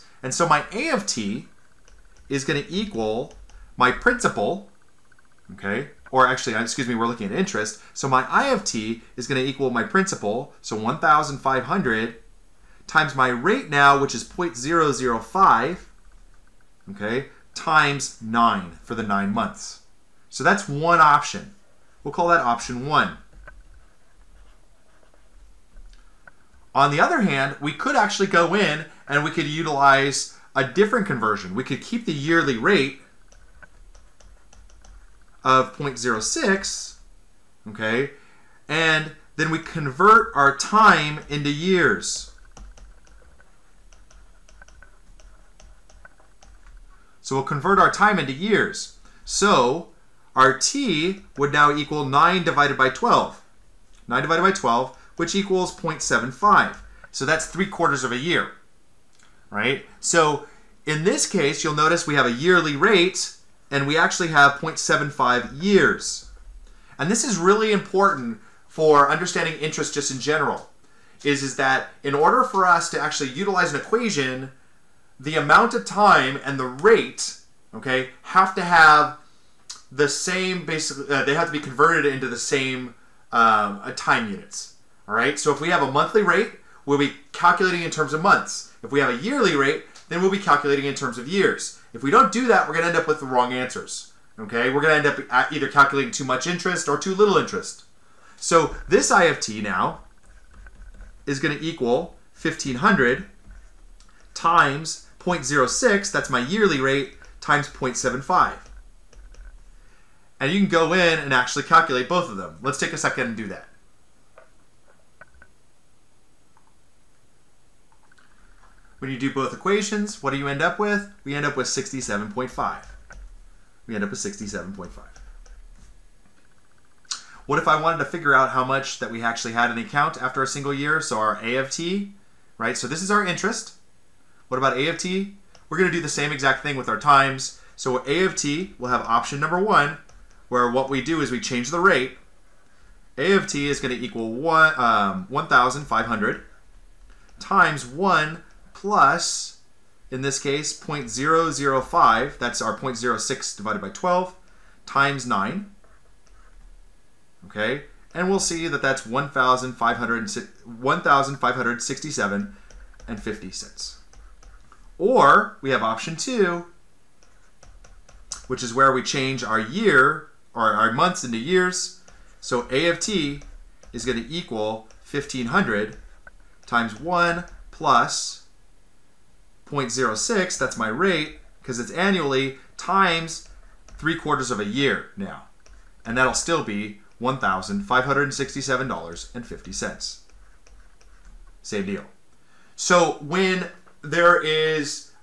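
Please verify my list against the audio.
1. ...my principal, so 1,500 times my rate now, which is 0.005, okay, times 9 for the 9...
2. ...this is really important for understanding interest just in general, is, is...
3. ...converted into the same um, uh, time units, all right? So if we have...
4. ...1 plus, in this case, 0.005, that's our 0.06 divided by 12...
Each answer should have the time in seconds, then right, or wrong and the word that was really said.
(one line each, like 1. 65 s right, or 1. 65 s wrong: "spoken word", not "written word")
1. 9 s right
2. 67 s right
3. 81 s right
4. 147 s right.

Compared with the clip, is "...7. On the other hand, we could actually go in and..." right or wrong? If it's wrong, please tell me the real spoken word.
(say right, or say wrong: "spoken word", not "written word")
wrong: "1", not "7".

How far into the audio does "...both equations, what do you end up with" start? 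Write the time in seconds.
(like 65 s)
119 s.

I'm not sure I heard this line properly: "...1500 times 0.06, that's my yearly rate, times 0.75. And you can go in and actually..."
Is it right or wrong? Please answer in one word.
right.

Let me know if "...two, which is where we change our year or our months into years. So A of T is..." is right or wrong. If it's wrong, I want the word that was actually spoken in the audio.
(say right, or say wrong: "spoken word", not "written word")
right.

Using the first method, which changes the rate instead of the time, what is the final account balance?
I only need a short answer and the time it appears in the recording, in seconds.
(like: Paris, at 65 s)
$1,567.50, at 159 s.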